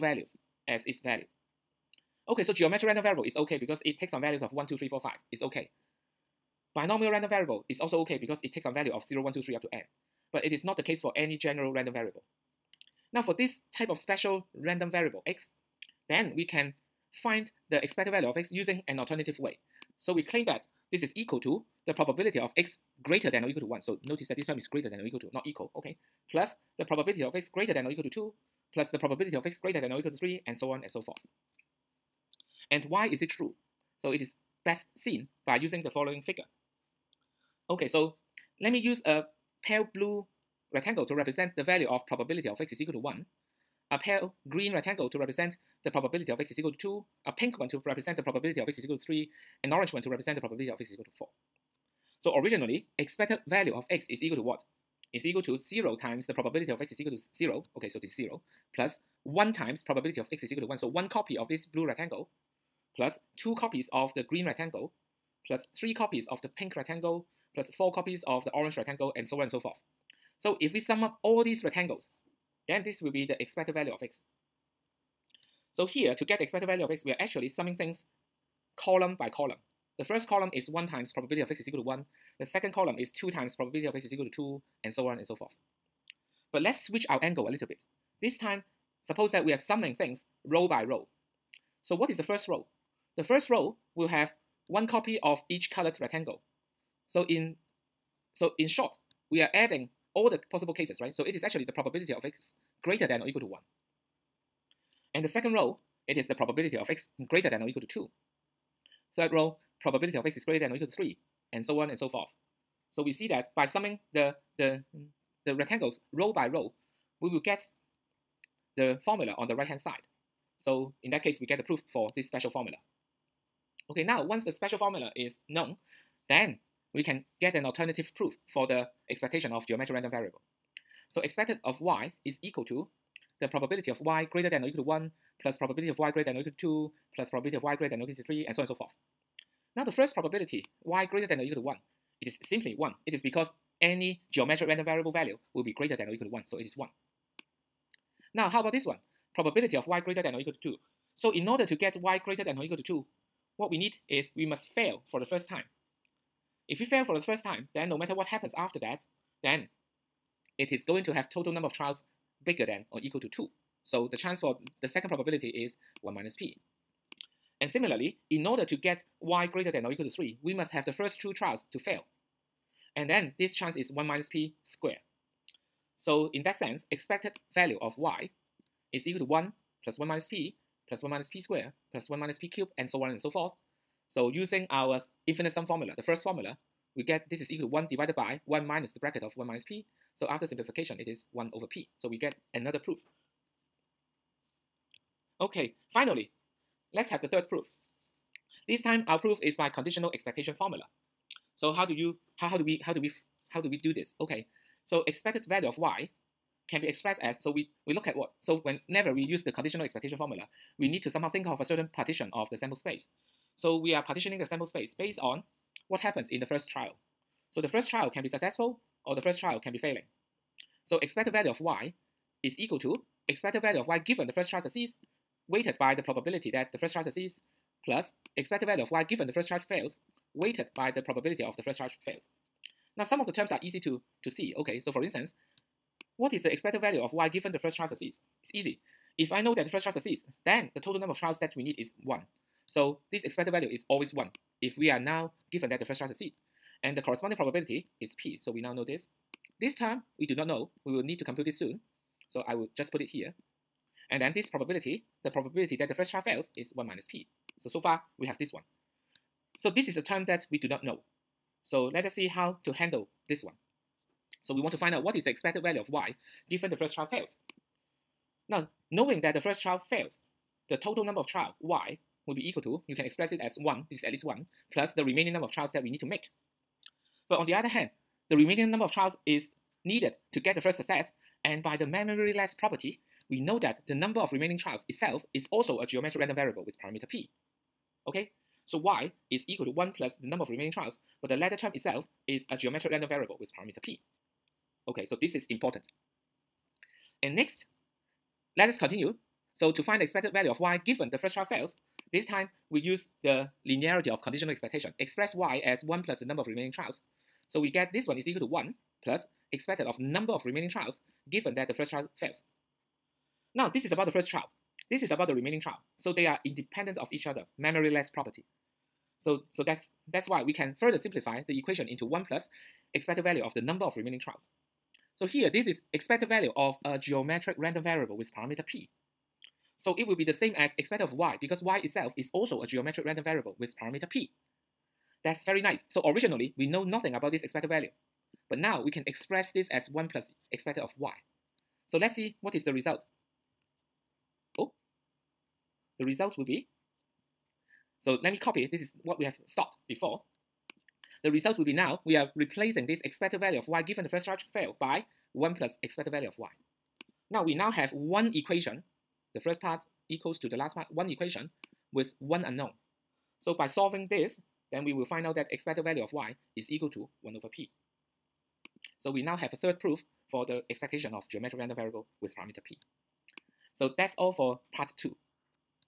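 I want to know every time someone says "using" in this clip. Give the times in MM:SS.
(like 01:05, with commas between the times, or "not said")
00:18, 00:35, 03:04.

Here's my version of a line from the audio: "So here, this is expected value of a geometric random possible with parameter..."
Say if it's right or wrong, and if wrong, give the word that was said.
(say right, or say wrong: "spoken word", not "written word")
wrong: "variable", not "possible".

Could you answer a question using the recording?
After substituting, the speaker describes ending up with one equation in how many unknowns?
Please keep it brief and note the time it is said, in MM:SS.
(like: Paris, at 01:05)
1, at 06:02.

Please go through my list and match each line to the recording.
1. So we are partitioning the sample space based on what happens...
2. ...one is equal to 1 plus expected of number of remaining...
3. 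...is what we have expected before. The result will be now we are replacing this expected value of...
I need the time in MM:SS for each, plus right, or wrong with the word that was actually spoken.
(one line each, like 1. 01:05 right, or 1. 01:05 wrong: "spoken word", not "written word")
1. 03:33 right
2. 05:08 right
3. 05:48 wrong: "stopped", not "expected".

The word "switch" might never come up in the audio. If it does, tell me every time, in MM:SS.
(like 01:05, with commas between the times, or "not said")
01:26.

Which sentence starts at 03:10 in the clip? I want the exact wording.
So after simplification, it is 1 over p.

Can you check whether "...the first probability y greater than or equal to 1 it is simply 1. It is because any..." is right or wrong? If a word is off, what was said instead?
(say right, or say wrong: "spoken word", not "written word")
right.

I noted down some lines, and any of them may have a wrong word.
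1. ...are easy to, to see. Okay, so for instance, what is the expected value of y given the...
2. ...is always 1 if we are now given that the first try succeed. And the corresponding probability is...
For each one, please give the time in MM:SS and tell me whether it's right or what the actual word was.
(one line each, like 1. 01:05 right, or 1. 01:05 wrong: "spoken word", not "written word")
1. 03:53 right
2. 04:03 right.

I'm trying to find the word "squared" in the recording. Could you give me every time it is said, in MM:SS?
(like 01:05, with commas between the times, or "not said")
02:54, 03:01.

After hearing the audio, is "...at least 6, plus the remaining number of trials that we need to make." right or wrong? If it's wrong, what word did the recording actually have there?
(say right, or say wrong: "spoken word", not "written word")
wrong: "1", not "6".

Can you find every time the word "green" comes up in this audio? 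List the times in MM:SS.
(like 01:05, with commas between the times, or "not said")
00:44, 01:04.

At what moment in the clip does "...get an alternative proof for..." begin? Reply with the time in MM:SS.
02:07.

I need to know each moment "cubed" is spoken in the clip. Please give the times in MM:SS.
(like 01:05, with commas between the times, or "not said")
03:02.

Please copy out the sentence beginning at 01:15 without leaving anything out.
So here, to get the expected value of x, we are actually summing things column by column.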